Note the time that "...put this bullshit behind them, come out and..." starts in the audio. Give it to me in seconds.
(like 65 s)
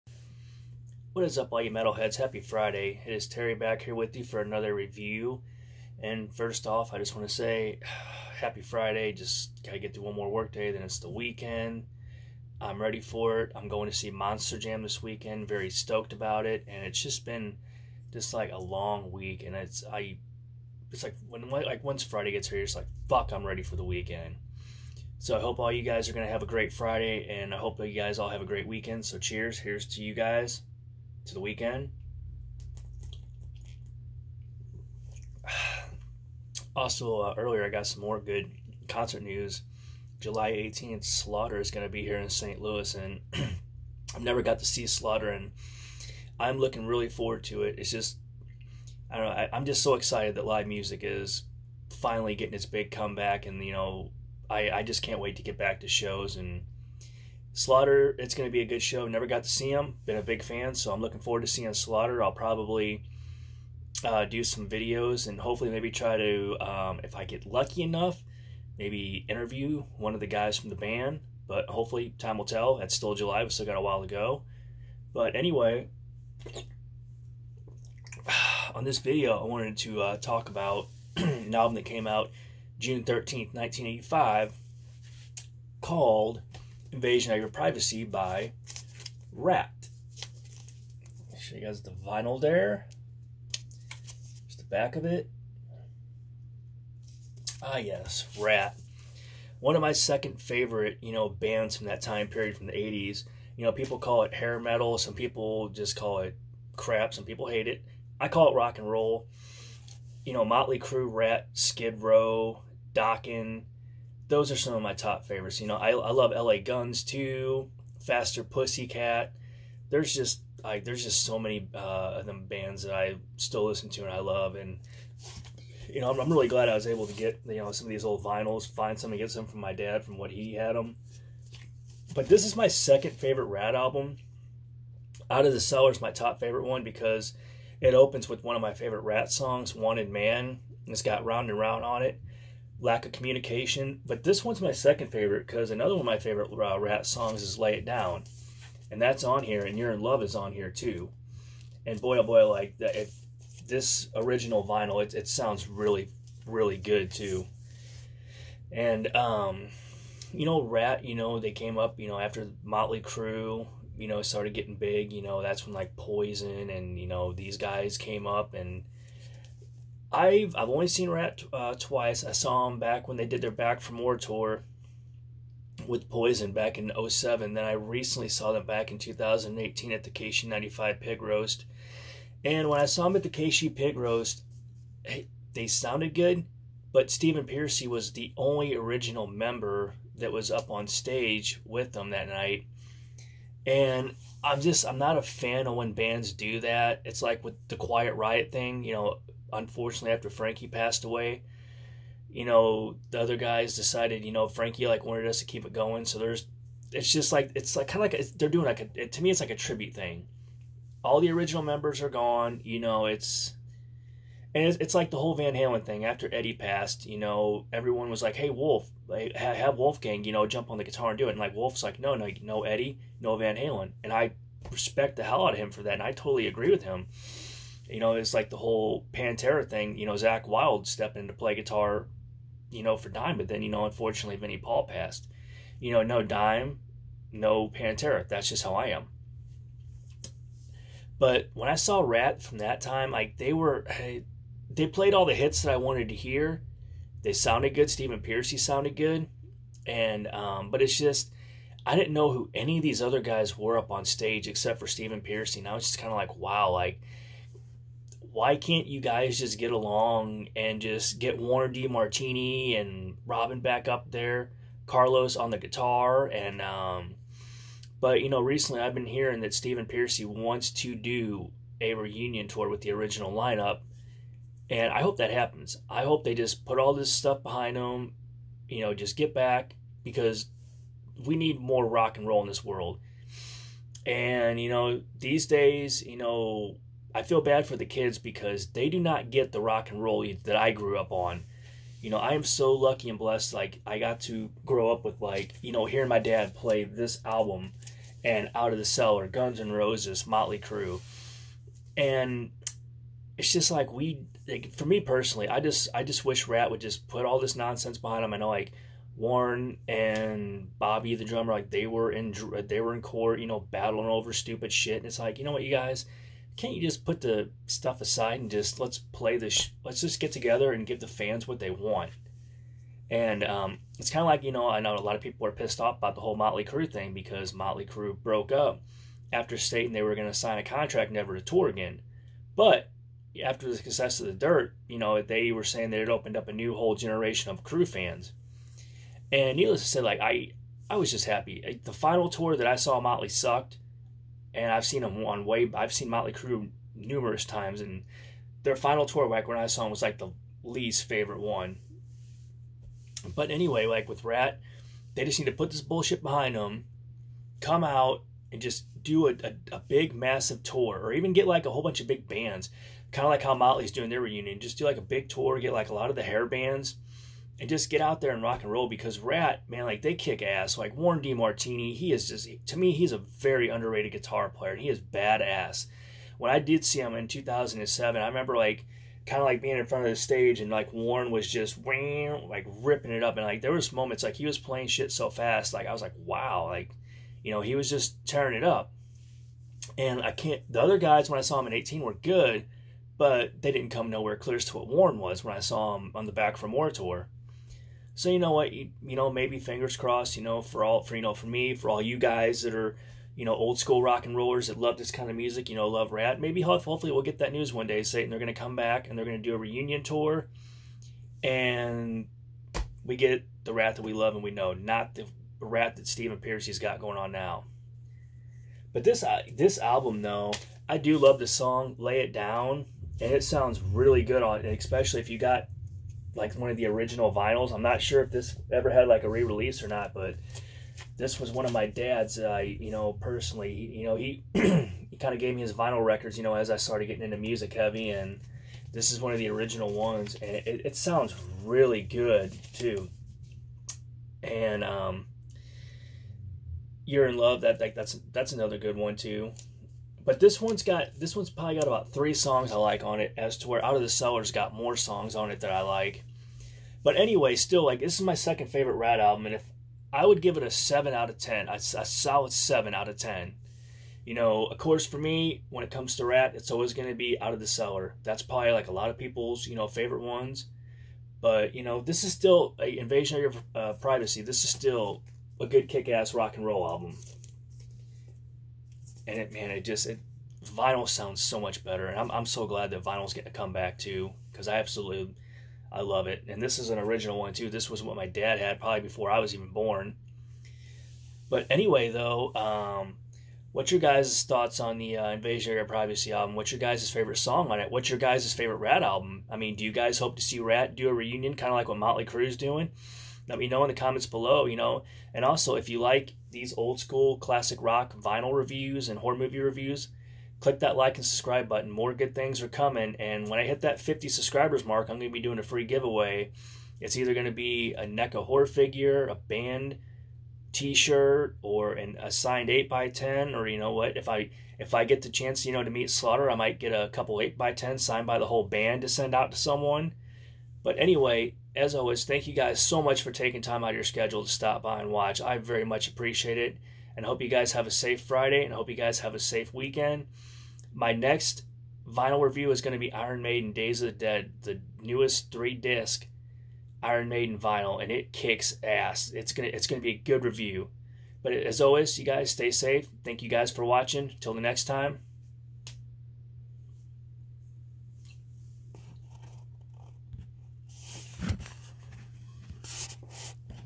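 355 s.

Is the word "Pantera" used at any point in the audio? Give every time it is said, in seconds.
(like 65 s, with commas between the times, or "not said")
229 s, 237 s.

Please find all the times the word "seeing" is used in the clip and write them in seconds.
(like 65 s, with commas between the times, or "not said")
61 s.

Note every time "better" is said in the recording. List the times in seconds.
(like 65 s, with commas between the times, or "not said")
481 s.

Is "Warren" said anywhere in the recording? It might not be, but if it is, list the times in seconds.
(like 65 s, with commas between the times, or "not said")
261 s, 309 s, 370 s, 380 s, 394 s.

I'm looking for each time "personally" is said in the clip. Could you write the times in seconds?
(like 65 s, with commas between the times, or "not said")
305 s, 433 s.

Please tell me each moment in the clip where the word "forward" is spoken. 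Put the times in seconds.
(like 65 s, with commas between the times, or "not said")
47 s, 61 s.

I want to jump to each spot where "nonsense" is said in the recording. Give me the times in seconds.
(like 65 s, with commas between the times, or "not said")
307 s.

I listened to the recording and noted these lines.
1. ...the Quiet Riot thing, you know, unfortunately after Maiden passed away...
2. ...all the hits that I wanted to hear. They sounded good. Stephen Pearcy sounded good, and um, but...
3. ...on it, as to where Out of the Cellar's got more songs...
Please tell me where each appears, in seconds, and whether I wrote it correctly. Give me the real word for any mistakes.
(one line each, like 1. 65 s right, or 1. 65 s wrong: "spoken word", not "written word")
1. 197 s wrong: "Frankie", not "Maiden"
2. 245 s right
3. 453 s right.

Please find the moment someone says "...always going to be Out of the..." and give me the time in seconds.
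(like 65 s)
466 s.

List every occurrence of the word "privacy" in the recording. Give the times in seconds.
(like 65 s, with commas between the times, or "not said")
87 s, 473 s, 495 s.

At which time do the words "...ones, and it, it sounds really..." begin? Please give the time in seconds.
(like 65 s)
439 s.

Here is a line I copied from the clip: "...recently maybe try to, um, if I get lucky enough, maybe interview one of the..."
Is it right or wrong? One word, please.
wrong.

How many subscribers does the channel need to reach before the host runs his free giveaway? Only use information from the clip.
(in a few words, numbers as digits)
50.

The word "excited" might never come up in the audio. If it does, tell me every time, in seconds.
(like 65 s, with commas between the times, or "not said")
49 s.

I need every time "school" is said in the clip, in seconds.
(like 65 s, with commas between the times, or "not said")
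403 s, 507 s.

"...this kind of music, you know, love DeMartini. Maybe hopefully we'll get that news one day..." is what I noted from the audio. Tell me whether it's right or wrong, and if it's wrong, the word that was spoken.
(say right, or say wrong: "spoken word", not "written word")
wrong: "Ratt", not "DeMartini".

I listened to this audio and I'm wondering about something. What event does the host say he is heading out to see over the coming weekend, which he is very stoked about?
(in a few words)
Monster Jam.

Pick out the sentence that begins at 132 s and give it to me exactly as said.
But this is my second favorite Ratt album.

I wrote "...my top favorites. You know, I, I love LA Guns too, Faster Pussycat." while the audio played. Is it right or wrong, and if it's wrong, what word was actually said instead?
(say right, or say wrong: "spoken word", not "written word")
right.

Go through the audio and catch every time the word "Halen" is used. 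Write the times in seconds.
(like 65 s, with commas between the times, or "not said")
215 s, 223 s.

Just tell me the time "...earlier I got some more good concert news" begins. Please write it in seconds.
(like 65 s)
37 s.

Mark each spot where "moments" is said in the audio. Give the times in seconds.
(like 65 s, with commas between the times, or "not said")
383 s.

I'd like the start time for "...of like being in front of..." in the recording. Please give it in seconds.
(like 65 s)
379 s.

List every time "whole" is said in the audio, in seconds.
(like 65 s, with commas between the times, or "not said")
215 s, 228 s, 326 s, 336 s, 361 s, 528 s.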